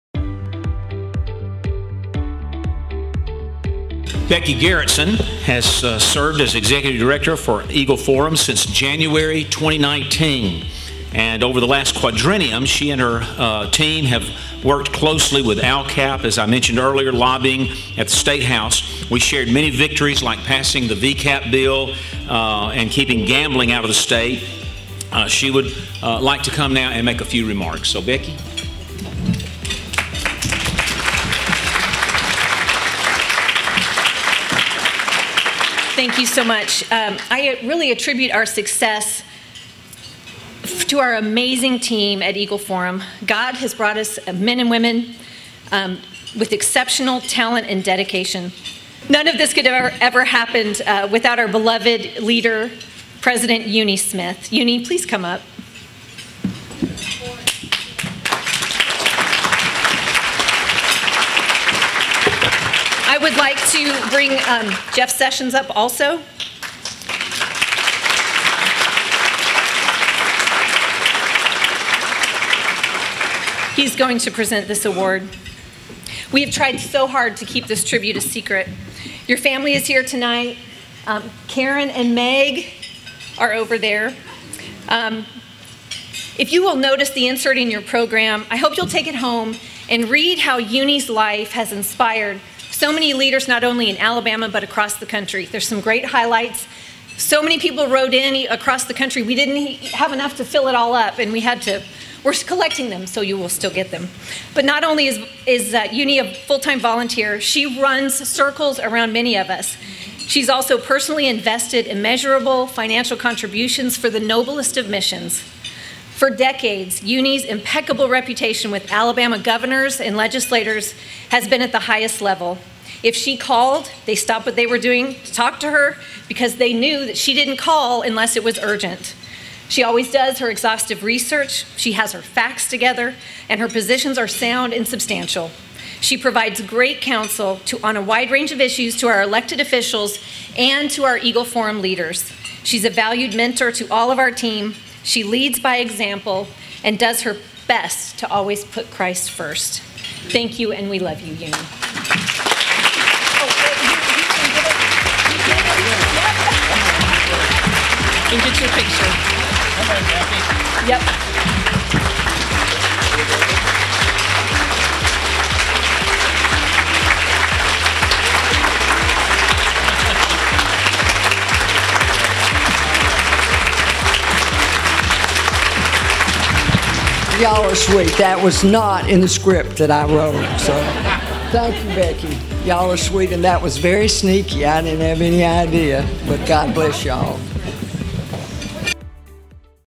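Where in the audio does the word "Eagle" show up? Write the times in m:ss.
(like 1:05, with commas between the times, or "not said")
0:07, 0:42, 2:21.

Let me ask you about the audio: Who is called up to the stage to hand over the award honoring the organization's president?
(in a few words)
Jeff Sessions.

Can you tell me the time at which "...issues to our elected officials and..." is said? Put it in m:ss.
2:18.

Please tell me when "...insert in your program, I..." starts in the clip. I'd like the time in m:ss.
1:27.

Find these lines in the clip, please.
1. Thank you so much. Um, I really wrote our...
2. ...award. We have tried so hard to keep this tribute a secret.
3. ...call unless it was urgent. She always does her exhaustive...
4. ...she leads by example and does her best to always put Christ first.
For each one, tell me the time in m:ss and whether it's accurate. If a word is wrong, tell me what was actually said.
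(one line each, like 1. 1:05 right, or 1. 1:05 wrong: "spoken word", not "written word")
1. 0:35 wrong: "attribute", not "wrote"
2. 1:14 right
3. 2:07 right
4. 2:25 right.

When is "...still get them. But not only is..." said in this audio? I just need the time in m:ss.
1:43.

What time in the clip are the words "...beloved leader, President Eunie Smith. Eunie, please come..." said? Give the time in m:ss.
0:51.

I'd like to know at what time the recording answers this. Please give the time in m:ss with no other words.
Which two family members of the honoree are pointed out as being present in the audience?
1:21.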